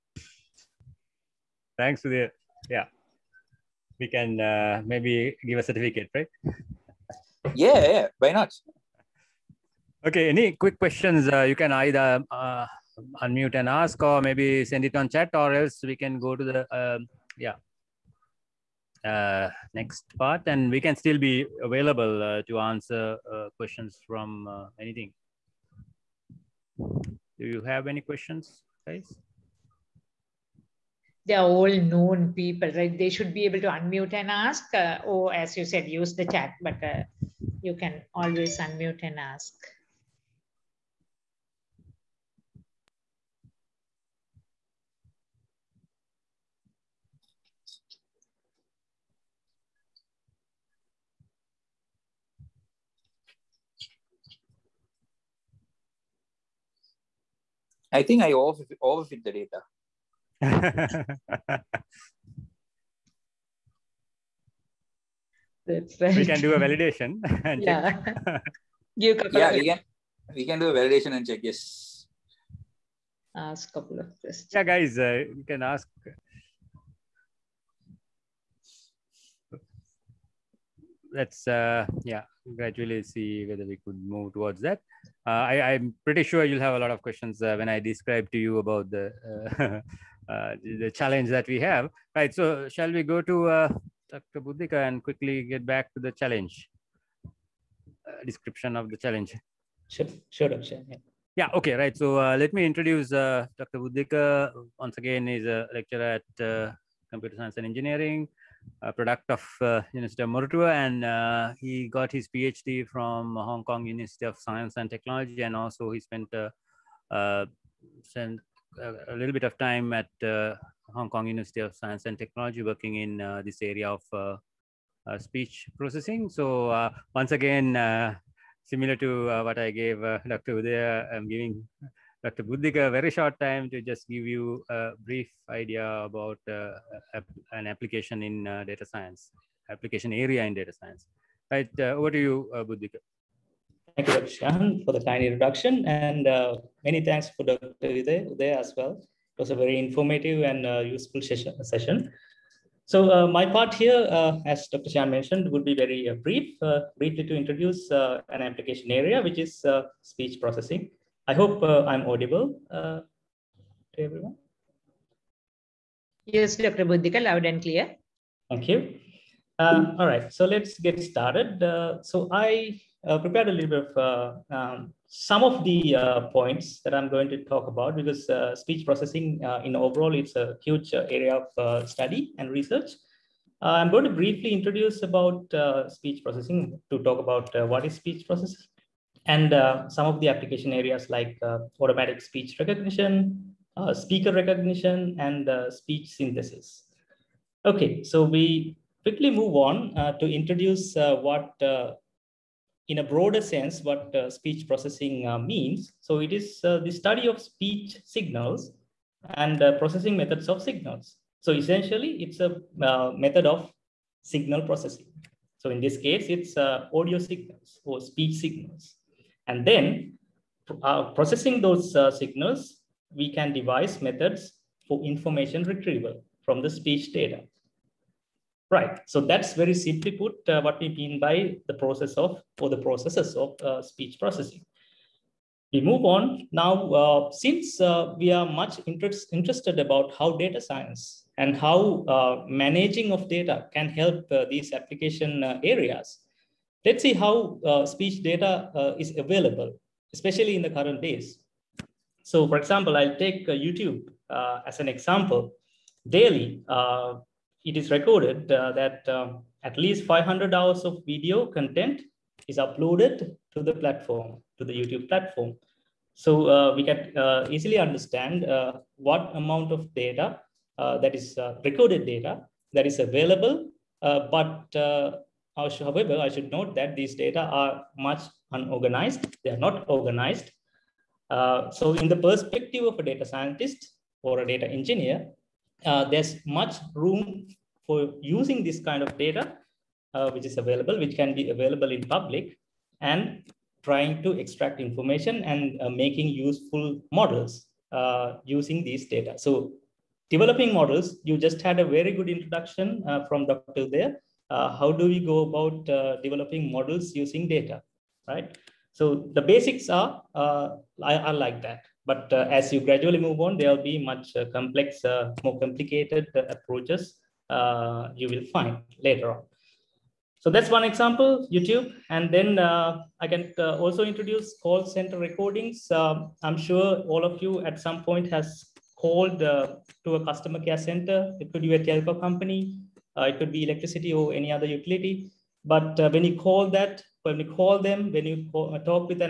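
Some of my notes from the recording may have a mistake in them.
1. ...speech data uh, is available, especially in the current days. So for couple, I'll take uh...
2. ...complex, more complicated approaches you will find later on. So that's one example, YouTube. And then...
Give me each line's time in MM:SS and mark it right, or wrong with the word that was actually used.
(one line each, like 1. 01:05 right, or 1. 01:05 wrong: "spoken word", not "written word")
1. 04:07 wrong: "example", not "couple"
2. 05:14 right.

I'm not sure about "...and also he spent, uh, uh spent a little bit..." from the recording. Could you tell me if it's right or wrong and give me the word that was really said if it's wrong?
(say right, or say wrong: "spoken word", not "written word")
right.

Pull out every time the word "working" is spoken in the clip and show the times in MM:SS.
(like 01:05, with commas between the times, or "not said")
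02:02.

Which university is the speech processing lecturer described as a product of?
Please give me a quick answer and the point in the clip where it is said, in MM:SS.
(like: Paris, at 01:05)
University of Moratuwa, at 01:49.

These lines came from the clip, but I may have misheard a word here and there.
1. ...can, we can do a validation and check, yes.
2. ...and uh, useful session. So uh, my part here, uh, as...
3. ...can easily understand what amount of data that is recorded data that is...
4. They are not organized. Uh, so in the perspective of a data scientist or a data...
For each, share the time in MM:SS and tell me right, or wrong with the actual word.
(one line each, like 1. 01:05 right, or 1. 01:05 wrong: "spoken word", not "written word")
1. 01:09 right
2. 02:30 right
3. 04:26 right
4. 04:39 right.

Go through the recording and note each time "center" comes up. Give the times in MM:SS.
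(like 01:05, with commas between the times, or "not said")
05:24, 05:30.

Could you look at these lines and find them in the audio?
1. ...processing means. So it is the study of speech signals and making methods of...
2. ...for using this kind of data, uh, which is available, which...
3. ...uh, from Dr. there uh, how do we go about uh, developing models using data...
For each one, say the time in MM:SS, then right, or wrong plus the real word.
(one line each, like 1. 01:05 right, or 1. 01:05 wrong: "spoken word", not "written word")
1. 03:24 wrong: "processing", not "making"
2. 04:47 right
3. 05:03 right.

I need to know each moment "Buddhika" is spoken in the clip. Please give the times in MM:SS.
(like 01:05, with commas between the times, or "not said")
01:34, 01:43, 02:12, 02:22, 02:46.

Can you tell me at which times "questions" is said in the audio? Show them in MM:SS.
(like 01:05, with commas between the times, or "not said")
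00:10, 00:23, 00:27, 01:14, 01:27.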